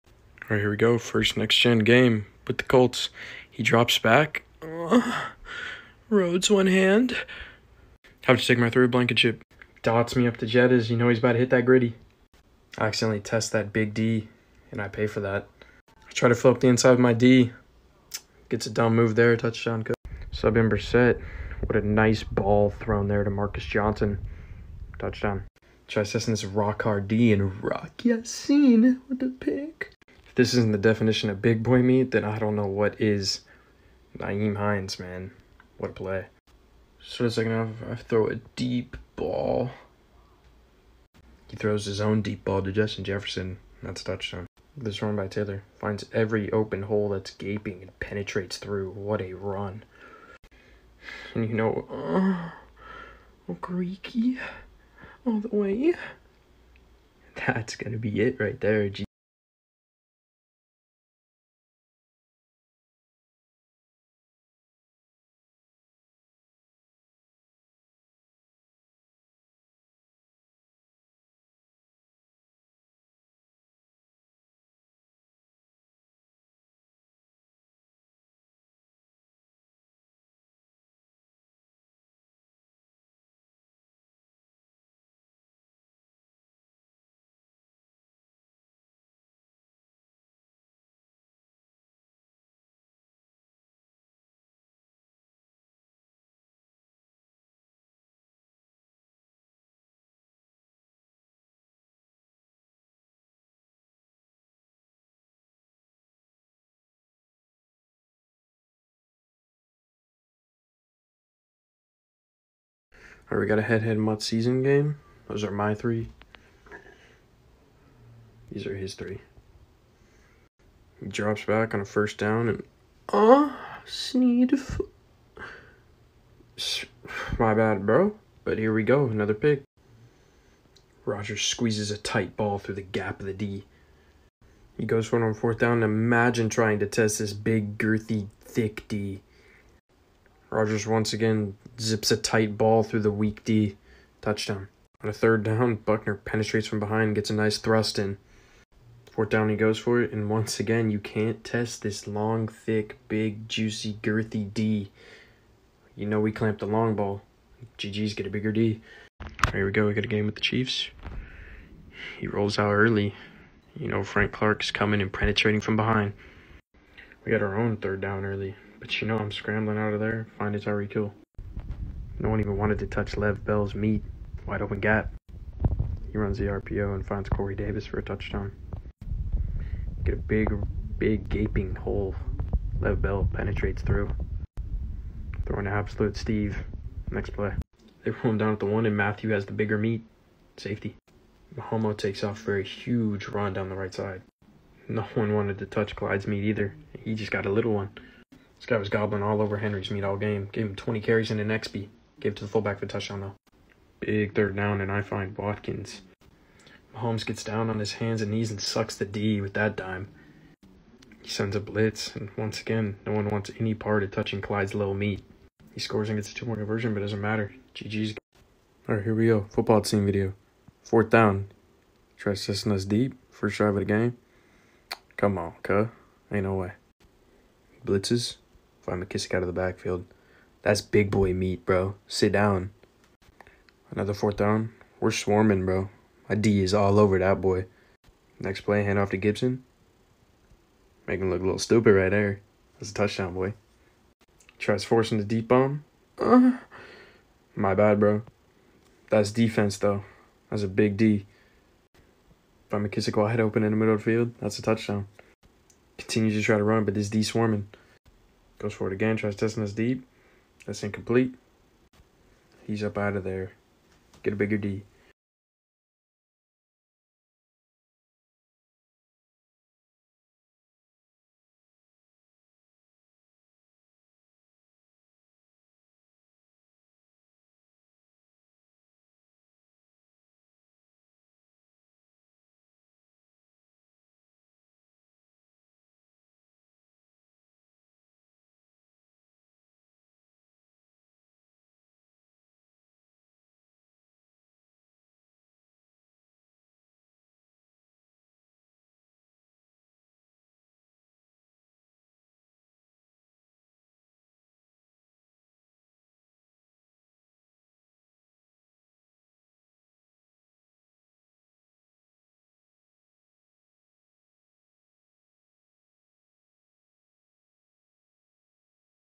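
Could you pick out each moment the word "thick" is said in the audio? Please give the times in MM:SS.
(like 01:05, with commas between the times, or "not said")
02:18, 02:32.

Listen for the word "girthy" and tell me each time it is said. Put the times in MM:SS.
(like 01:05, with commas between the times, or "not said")
02:17, 02:34.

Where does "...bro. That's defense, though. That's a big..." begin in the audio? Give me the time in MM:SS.
04:07.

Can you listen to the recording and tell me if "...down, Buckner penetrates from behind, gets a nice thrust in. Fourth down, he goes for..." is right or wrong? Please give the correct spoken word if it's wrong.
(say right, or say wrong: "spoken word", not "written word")
right.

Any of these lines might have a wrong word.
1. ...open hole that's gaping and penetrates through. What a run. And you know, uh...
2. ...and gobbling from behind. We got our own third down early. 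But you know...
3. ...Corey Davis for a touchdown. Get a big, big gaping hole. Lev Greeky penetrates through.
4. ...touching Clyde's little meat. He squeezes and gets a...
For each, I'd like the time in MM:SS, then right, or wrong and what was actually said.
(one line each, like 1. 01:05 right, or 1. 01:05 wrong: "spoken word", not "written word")
1. 00:46 right
2. 02:45 wrong: "penetrating", not "gobbling"
3. 02:57 wrong: "Bell", not "Greeky"
4. 03:34 wrong: "scores", not "squeezes".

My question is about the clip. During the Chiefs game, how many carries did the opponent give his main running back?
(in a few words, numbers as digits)
20.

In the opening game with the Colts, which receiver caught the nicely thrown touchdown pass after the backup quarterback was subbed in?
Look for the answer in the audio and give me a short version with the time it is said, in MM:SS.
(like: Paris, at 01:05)
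Marcus Johnson, at 00:23.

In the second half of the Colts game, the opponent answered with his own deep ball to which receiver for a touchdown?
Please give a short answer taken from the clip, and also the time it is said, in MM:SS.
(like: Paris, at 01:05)
Justin Jefferson, at 00:42.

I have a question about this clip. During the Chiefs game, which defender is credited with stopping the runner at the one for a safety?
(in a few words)
Mathieu.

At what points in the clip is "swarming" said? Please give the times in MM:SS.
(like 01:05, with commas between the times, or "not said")
03:55, 04:17.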